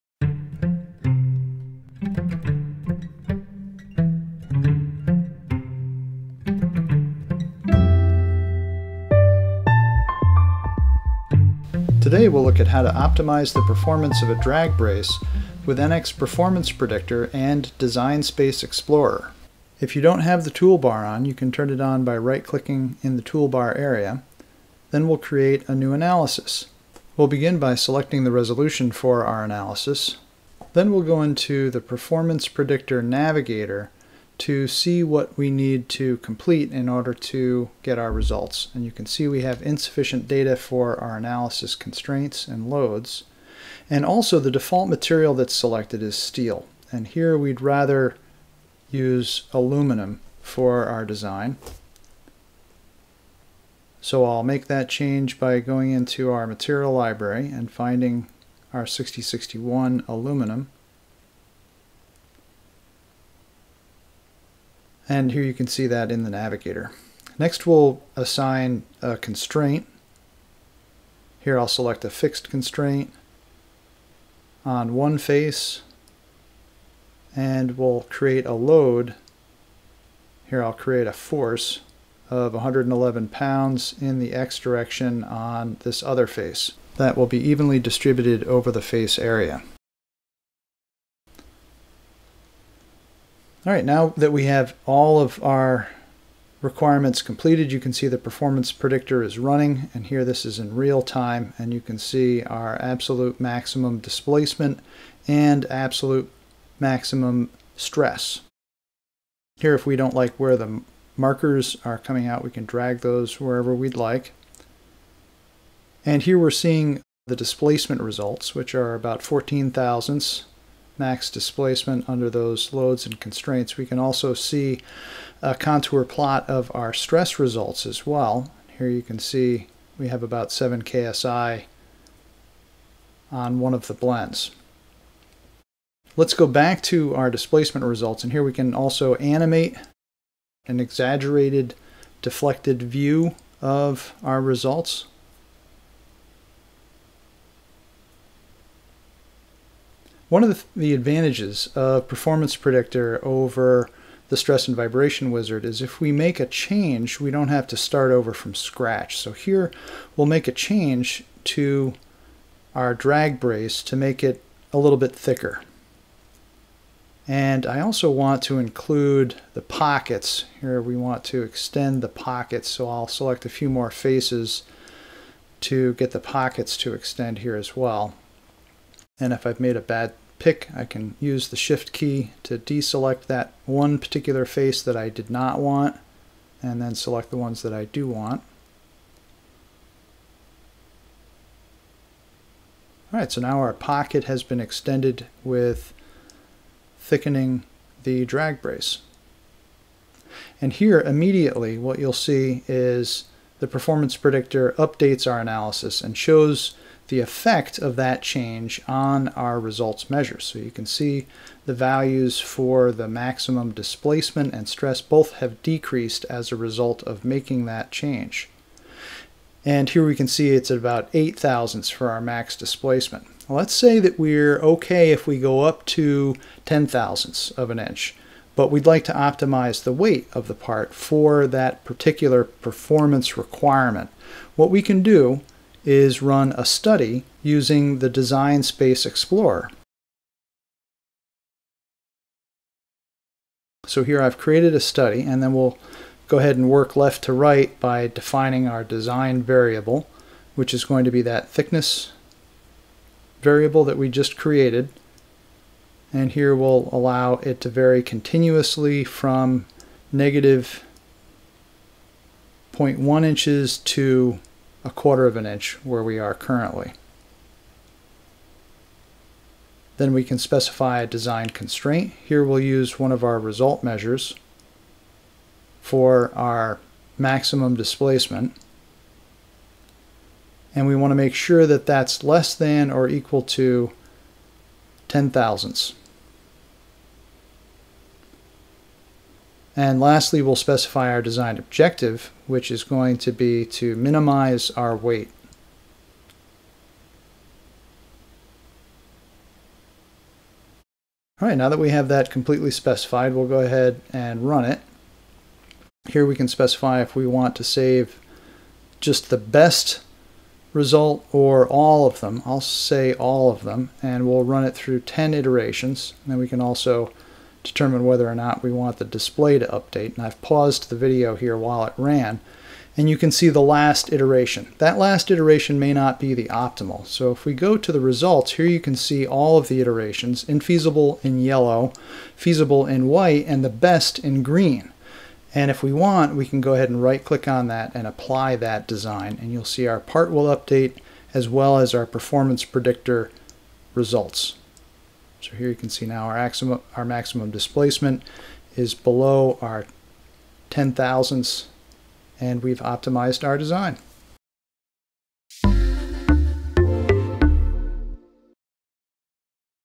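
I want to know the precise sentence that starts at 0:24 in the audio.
Then we'll create a new analysis.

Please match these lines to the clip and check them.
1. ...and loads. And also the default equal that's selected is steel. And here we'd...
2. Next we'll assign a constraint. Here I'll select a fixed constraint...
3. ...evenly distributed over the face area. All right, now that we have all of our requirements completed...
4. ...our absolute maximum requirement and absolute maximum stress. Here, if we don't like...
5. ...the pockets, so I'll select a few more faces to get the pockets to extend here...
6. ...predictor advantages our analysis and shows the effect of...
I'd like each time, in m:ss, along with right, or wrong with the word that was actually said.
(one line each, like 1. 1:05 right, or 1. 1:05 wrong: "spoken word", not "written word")
1. 0:42 wrong: "material", not "equal"
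2. 1:07 right
3. 1:27 right
4. 1:42 wrong: "displacement", not "requirement"
5. 2:52 right
6. 3:24 wrong: "updates", not "advantages".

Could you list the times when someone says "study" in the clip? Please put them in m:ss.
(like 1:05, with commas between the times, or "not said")
3:56, 4:04.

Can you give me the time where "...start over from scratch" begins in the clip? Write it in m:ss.
2:37.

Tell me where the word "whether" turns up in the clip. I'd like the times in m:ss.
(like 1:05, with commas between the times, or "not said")
5:18.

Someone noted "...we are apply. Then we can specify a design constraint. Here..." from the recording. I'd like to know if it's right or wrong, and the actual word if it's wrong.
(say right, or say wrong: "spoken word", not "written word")
wrong: "currently", not "apply".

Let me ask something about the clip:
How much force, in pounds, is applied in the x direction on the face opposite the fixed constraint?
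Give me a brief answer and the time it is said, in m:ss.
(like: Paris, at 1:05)
111 pounds, at 1:22.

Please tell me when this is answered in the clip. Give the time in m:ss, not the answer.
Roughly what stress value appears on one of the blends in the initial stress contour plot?
2:10.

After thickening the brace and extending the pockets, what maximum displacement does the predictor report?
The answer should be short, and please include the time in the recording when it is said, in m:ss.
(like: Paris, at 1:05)
8 thousandths, at 3:41.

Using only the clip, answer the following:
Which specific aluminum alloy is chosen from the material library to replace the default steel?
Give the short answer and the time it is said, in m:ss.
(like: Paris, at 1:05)
6061 aluminum, at 0:58.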